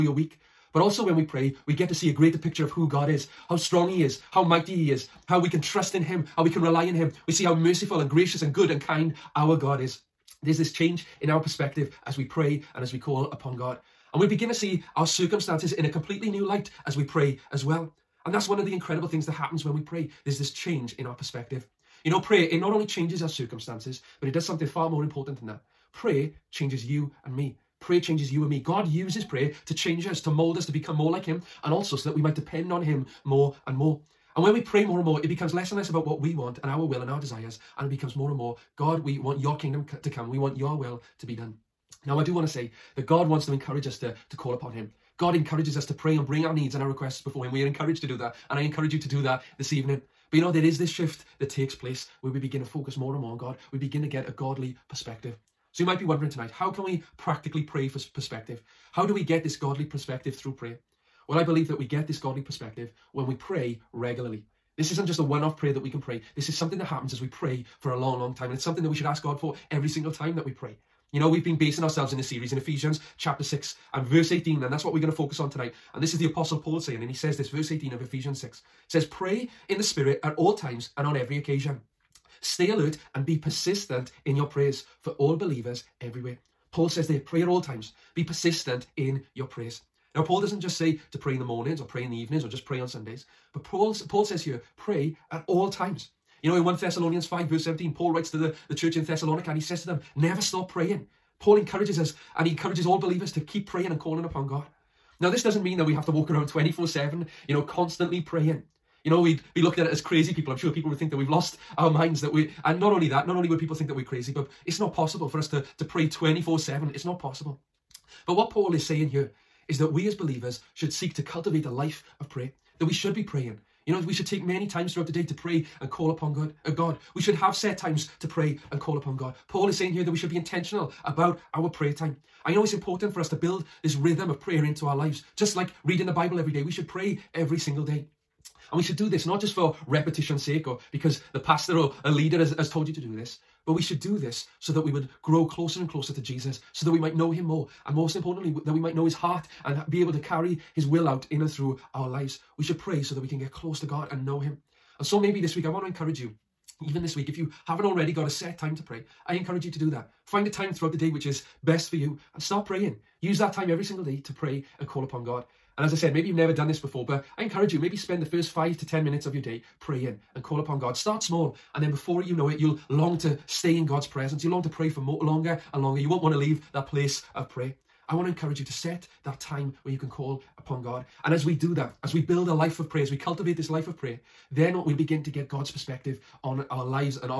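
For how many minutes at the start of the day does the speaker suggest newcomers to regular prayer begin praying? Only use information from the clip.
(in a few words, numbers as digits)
5 to 10 minutes.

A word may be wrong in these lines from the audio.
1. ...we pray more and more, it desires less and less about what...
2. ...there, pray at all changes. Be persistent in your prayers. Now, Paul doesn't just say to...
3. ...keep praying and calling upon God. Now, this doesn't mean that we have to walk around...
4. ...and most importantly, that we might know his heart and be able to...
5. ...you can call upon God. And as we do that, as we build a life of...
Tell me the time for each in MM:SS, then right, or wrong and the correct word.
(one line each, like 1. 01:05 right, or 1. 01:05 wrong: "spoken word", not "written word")
1. 00:34 wrong: "becomes", not "desires"
2. 01:27 wrong: "times", not "changes"
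3. 01:43 right
4. 02:27 right
5. 02:59 right.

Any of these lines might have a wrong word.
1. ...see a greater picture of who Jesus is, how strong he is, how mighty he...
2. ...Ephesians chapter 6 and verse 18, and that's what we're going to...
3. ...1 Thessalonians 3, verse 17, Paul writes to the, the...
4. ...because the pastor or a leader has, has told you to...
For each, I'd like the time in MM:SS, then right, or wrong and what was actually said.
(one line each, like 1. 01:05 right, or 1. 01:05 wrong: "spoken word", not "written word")
1. 00:01 wrong: "God", not "Jesus"
2. 01:12 right
3. 01:36 wrong: "5", not "3"
4. 02:20 right.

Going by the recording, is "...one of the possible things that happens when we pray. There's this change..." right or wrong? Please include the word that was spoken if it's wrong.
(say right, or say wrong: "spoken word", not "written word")
wrong: "incredible", not "possible".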